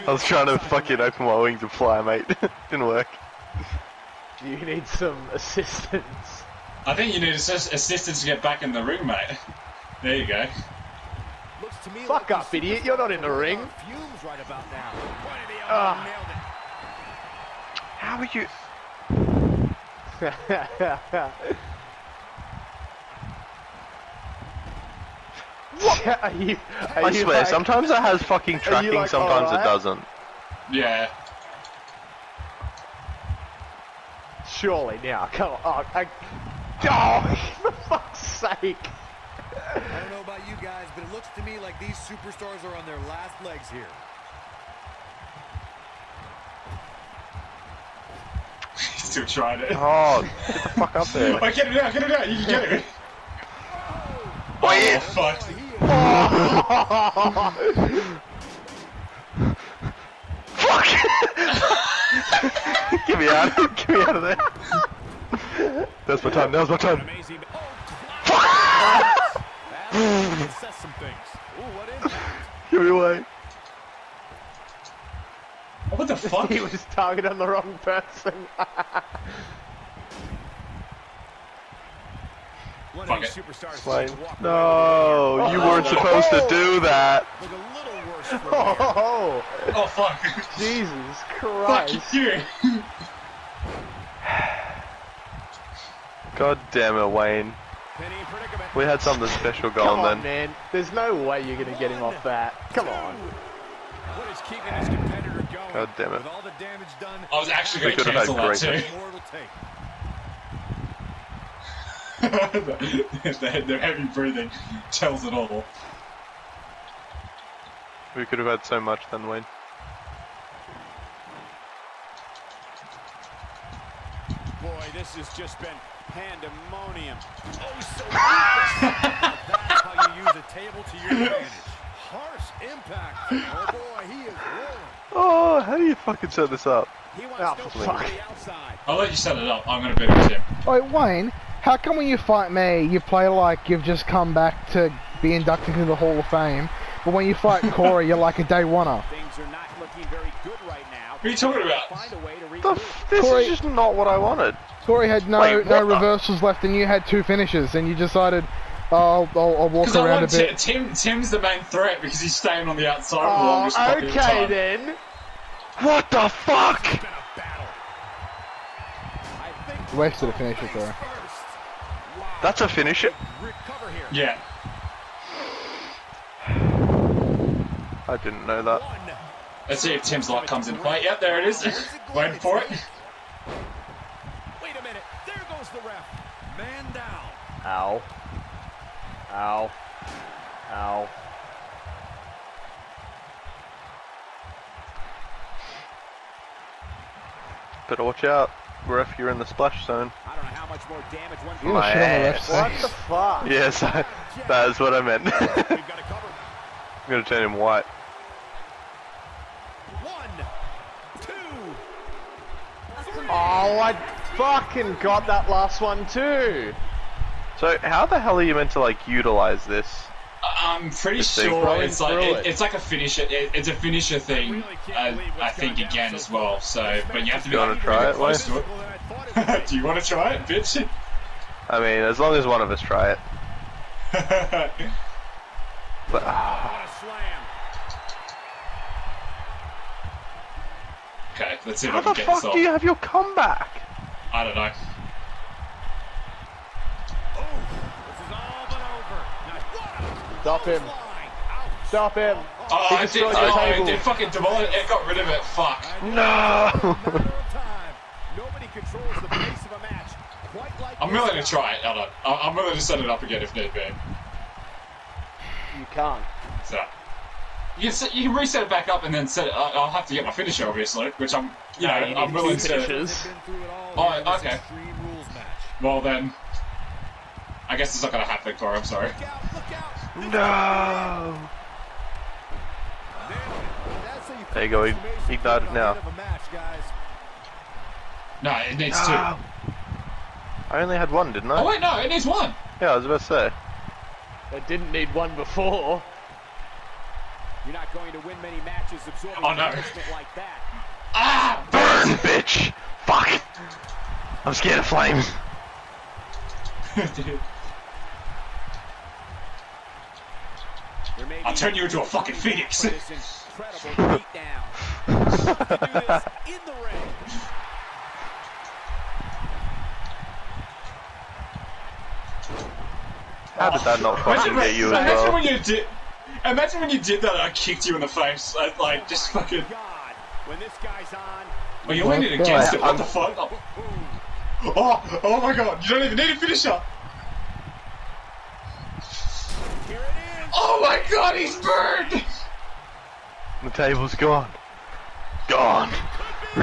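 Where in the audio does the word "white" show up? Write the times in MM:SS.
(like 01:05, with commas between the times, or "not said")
03:27.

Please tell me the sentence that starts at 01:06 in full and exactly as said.
That's my time, now's my time.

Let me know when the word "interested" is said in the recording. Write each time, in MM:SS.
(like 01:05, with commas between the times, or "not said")
not said.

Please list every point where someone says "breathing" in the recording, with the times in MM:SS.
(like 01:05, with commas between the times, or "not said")
01:54.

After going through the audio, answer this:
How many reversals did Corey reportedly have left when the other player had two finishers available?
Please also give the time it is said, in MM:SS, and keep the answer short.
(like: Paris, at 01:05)
0, at 02:35.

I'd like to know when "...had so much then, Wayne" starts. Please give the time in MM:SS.
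01:58.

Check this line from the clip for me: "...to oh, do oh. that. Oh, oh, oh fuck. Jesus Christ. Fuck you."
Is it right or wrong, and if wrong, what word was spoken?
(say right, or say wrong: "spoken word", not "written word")
right.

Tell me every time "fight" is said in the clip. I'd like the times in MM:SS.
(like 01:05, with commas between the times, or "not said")
02:22, 02:27.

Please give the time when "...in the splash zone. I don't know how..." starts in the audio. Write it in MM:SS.
03:19.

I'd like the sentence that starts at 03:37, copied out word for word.
So how the hell are you meant to like utilize this?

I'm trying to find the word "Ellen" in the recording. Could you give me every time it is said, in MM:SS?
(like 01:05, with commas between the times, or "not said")
04:21.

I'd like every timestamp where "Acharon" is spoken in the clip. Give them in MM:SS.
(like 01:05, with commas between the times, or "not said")
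not said.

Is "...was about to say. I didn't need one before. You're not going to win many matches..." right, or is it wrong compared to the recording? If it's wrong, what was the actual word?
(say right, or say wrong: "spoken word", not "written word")
right.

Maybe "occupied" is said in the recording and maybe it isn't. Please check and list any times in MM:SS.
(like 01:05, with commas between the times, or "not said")
not said.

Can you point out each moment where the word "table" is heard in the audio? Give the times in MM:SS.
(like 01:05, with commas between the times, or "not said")
02:10, 04:13, 05:43.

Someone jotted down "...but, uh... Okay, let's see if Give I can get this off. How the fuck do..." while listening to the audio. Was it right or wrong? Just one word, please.
wrong.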